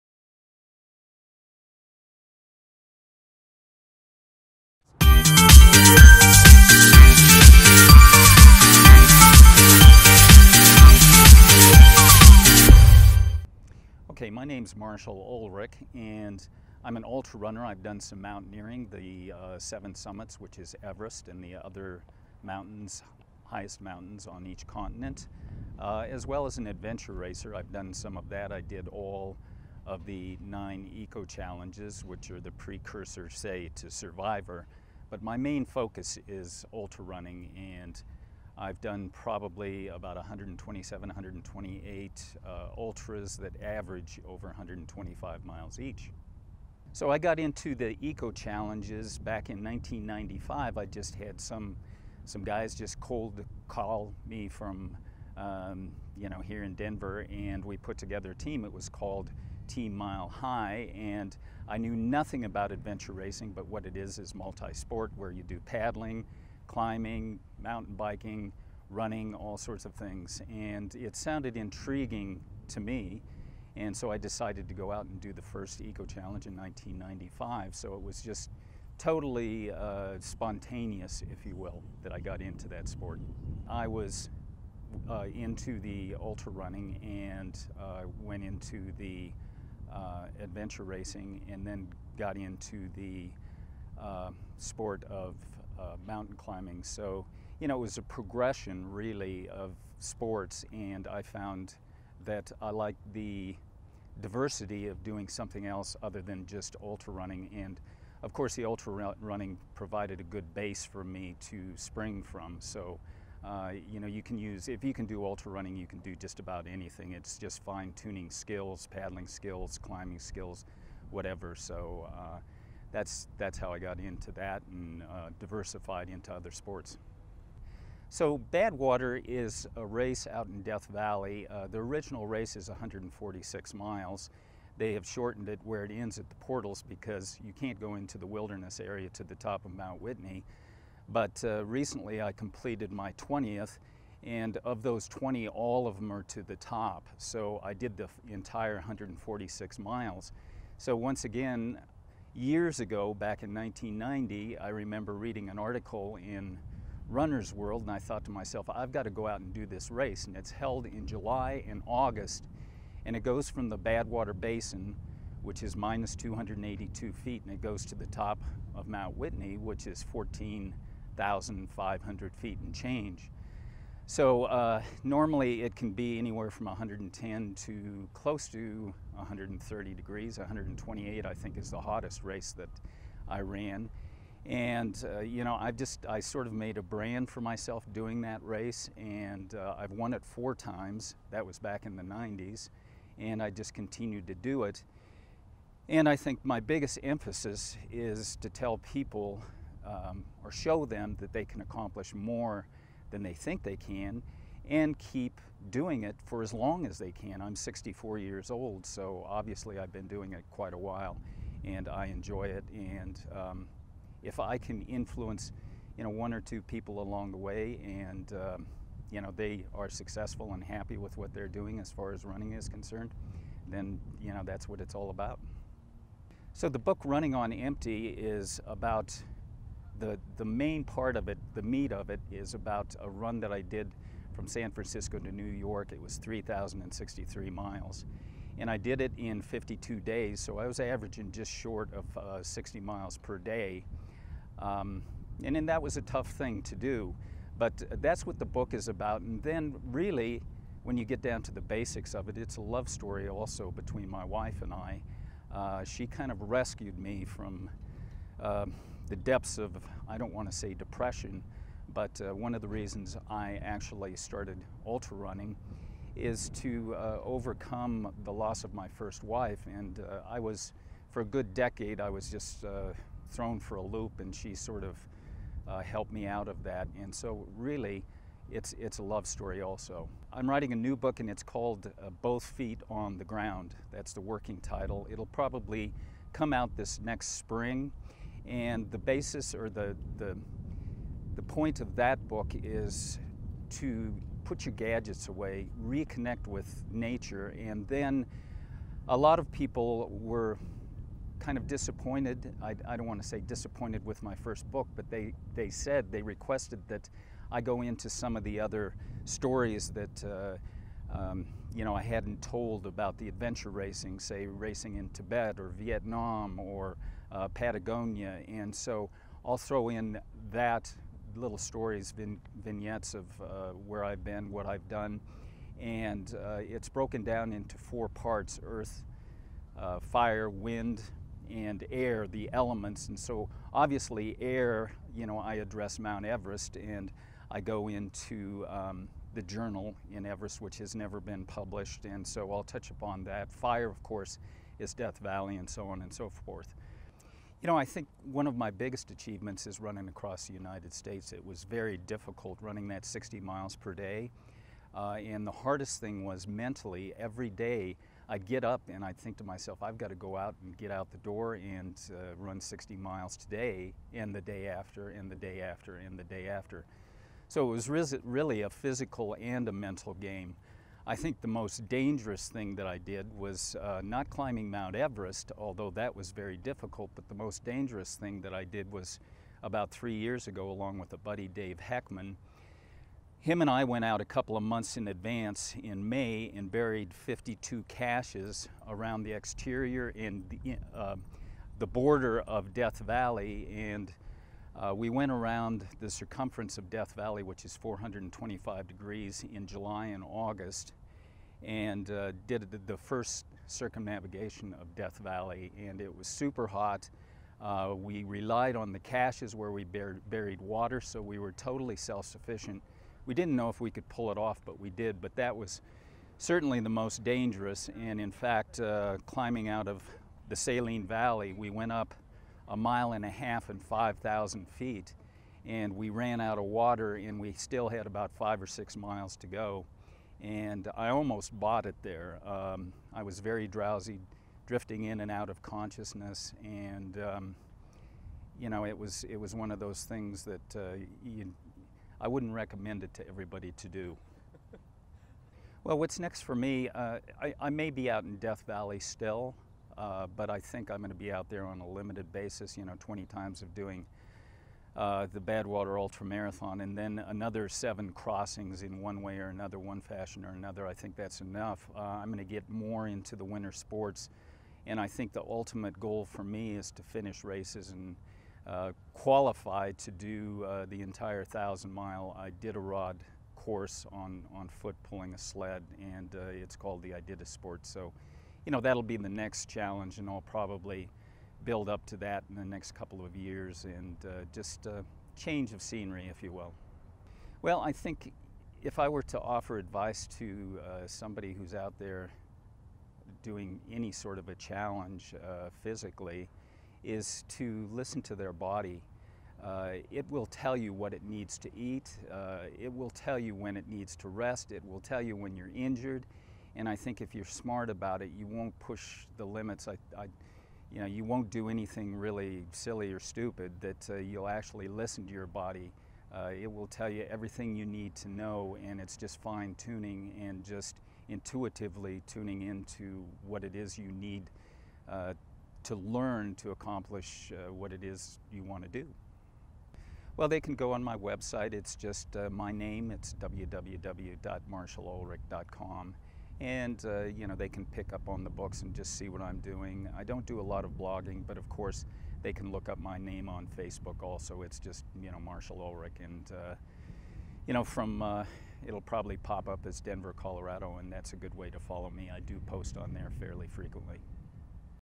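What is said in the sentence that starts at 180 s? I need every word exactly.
128, I think, is the hottest race that I ran.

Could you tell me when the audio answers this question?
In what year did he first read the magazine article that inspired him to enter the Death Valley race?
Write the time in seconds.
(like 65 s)
153 s.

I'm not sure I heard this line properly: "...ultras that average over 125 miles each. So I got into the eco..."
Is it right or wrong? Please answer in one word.
right.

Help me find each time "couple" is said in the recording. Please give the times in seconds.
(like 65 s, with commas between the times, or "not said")
384 s, 482 s.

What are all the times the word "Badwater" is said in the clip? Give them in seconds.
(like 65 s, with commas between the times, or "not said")
128 s, 163 s, 455 s.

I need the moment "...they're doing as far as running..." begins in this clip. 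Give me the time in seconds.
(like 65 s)
221 s.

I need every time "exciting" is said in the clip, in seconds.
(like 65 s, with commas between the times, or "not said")
not said.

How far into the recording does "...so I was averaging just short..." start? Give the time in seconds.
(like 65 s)
240 s.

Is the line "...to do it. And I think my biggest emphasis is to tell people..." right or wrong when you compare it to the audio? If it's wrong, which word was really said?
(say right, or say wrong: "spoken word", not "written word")
right.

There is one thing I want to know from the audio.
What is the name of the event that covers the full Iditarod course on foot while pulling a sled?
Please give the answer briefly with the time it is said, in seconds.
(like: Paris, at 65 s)
Iditasport, at 477 s.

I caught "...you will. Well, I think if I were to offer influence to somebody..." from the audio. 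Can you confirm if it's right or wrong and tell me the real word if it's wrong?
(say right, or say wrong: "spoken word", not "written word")
wrong: "advice", not "influence".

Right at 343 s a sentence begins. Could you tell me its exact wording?
Fire, of course, is Death Valley and so on and so forth.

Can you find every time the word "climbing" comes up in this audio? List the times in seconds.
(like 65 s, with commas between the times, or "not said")
66 s, 96 s, 119 s, 374 s, 419 s.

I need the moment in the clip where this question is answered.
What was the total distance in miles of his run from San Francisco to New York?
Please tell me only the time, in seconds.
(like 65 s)
236 s.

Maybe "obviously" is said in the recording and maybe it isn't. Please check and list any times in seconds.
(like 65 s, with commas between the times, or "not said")
209 s, 333 s.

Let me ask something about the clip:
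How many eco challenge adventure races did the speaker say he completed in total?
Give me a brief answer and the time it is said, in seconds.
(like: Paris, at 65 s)
9, at 30 s.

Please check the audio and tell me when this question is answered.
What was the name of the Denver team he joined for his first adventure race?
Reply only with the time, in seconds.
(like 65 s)
59 s.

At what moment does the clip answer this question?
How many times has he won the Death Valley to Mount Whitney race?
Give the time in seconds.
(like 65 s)
190 s.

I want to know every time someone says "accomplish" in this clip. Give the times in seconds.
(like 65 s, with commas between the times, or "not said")
201 s, 526 s.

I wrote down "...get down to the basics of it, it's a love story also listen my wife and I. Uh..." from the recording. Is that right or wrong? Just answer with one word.
wrong.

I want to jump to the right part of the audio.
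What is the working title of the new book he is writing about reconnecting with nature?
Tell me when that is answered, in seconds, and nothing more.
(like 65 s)
282 s.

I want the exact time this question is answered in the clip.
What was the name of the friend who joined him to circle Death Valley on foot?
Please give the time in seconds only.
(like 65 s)
381 s.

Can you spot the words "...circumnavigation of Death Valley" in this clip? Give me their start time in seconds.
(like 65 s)
403 s.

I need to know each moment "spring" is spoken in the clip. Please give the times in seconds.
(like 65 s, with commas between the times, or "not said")
111 s, 287 s.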